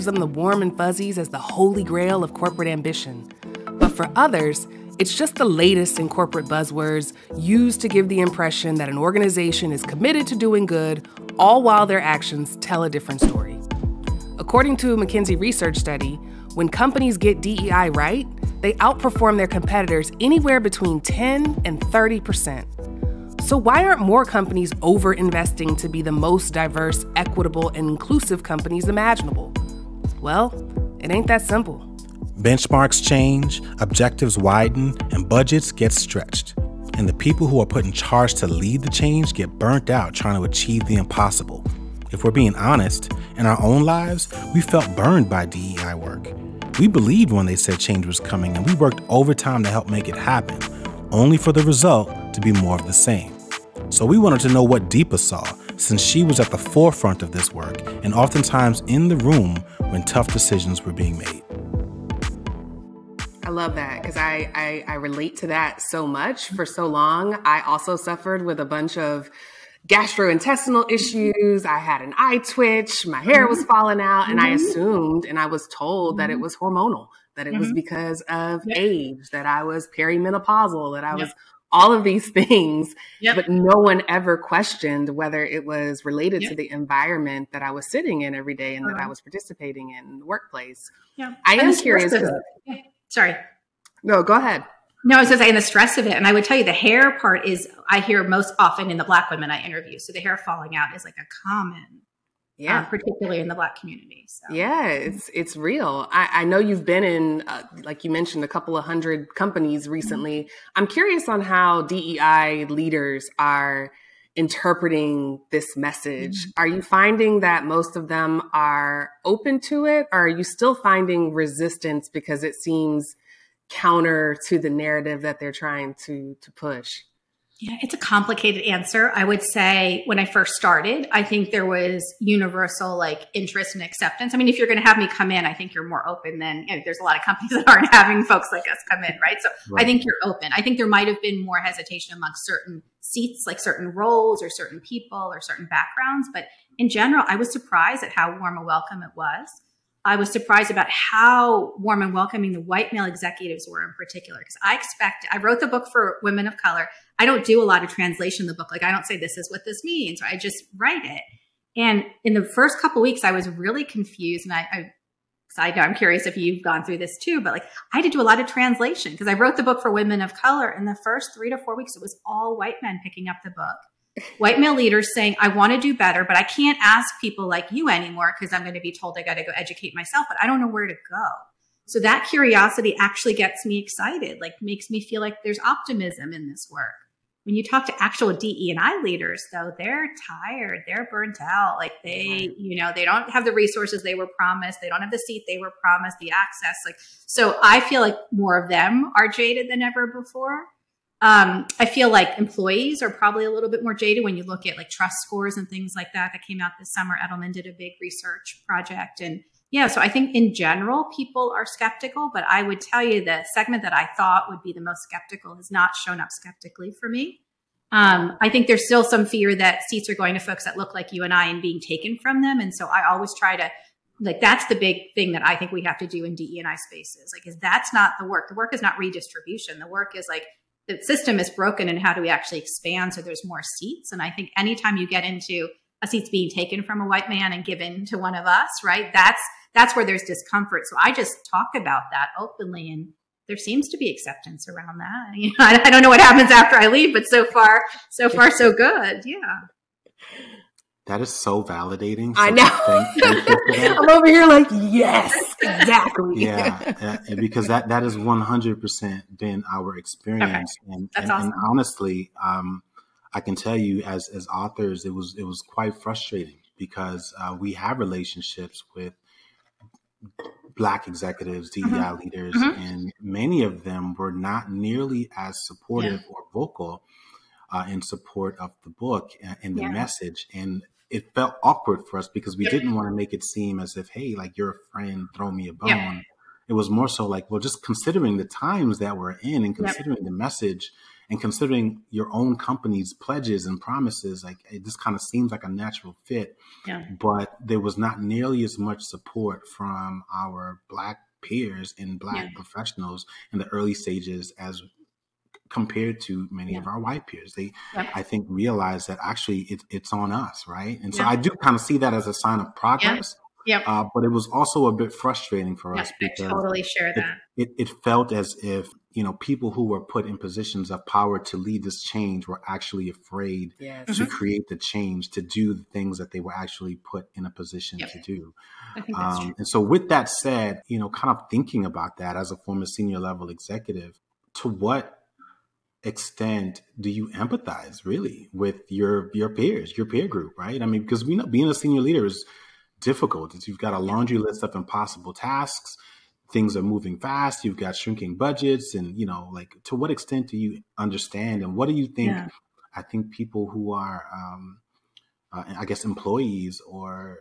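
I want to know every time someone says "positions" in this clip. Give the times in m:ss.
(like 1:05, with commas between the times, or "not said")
5:20, 5:27.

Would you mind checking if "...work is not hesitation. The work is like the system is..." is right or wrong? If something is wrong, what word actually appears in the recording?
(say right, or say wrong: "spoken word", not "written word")
wrong: "redistribution", not "hesitation".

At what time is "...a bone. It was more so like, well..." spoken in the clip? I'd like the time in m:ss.
4:45.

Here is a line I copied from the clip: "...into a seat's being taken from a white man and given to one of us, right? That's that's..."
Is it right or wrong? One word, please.
right.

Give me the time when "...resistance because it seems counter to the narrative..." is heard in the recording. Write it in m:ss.
2:01.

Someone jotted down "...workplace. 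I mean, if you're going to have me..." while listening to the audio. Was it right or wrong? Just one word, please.
wrong.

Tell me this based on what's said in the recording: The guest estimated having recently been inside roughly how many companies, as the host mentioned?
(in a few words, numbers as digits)
a couple of hundred.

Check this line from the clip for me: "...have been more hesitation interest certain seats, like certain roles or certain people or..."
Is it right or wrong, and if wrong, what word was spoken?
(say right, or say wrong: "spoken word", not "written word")
wrong: "amongst", not "interest".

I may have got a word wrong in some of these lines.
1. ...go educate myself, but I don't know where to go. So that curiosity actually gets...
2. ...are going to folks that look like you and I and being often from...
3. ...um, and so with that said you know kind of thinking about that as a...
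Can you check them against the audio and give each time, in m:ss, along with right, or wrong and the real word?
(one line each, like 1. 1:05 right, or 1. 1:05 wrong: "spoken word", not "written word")
1. 2:59 right
2. 3:40 wrong: "taken", not "often"
3. 5:29 right.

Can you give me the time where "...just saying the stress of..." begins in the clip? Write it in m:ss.
1:35.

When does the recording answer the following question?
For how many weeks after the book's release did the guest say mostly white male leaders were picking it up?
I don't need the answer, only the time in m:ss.
2:51.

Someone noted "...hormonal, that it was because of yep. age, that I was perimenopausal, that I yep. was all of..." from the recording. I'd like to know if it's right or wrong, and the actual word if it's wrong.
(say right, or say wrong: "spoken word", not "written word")
right.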